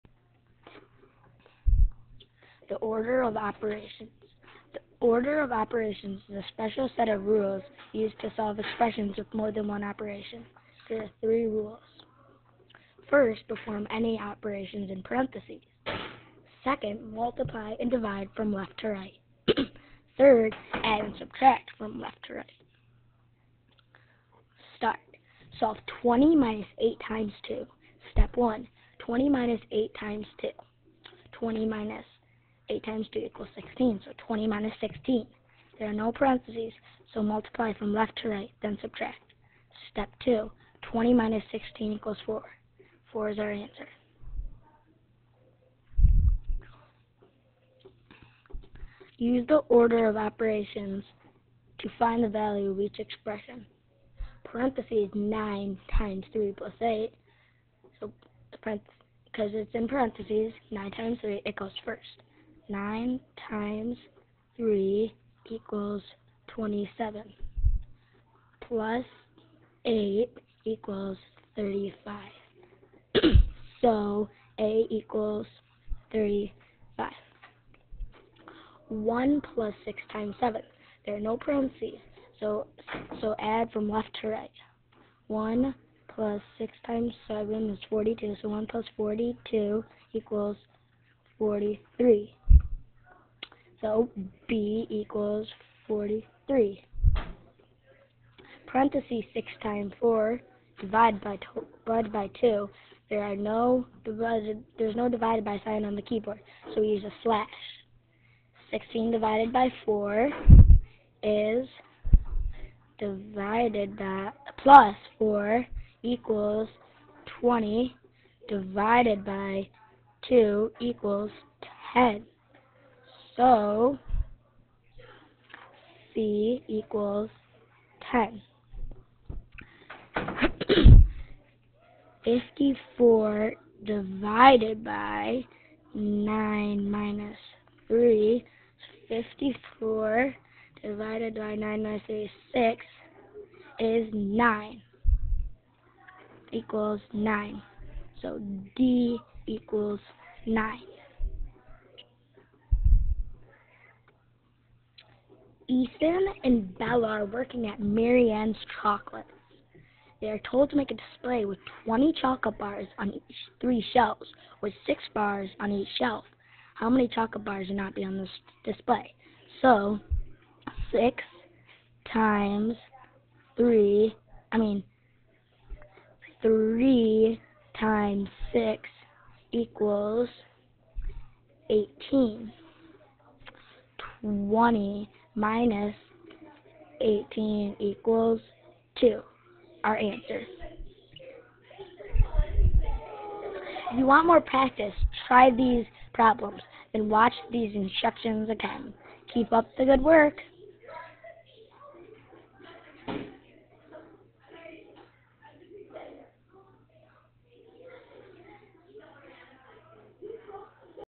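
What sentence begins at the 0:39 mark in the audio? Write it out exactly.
Step 2, 20 minus 16 equals 4.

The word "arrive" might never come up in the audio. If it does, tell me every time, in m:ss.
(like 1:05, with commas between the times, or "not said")
not said.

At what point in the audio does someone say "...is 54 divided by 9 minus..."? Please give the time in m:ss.
2:19.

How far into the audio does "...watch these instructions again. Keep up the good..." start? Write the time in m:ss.
3:17.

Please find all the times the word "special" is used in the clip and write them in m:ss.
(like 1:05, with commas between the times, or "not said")
0:06.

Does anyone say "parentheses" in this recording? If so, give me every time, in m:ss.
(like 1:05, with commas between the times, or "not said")
0:15, 0:36, 0:54, 0:59, 1:21, 1:38.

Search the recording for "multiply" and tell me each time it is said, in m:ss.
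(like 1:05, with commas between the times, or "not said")
0:17, 0:37.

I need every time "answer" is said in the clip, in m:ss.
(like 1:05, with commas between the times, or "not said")
0:43, 3:09.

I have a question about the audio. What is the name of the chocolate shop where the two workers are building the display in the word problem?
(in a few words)
Marianne's Chocolates.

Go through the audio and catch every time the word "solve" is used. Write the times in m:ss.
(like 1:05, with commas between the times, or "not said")
0:08, 0:25.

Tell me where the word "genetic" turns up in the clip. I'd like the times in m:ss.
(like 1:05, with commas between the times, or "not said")
not said.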